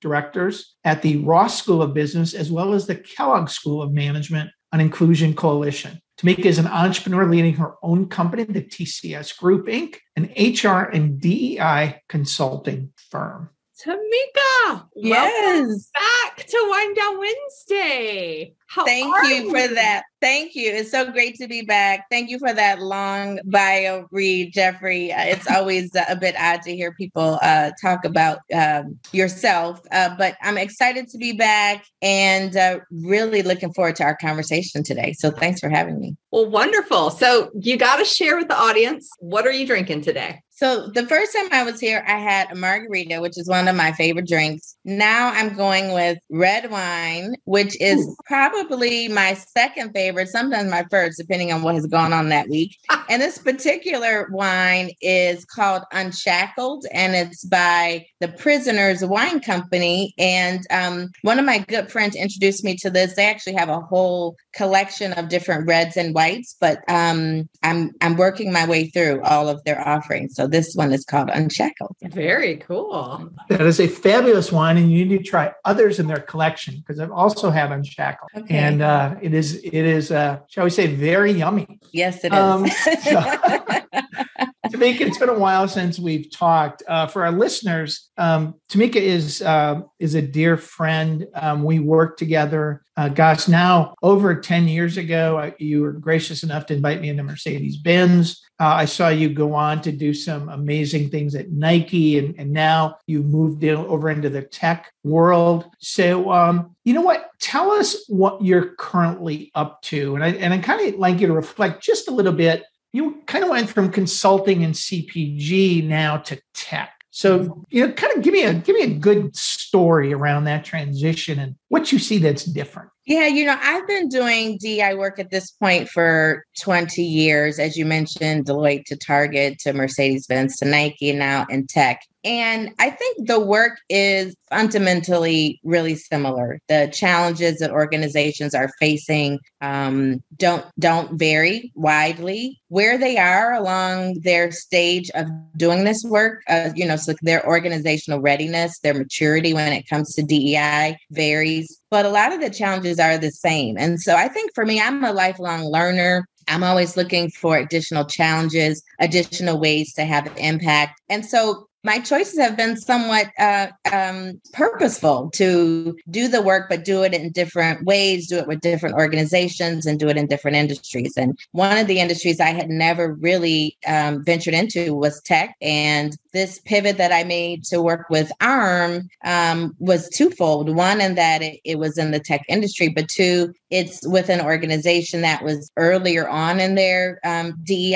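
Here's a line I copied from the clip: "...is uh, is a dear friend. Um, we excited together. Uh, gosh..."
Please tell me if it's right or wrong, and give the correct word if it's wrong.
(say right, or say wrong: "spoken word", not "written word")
wrong: "worked", not "excited".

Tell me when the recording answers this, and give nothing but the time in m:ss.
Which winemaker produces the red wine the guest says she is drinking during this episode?
0:58.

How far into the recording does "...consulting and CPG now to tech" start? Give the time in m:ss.
1:53.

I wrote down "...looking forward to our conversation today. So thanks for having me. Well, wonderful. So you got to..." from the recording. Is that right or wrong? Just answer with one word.
right.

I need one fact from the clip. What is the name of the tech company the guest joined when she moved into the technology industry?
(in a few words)
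ARM.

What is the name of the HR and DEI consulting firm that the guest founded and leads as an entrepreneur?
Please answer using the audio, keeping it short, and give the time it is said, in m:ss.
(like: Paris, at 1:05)
TCS Group Inc., at 0:08.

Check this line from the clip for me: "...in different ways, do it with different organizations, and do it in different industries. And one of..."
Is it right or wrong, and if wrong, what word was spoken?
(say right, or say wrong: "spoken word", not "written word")
right.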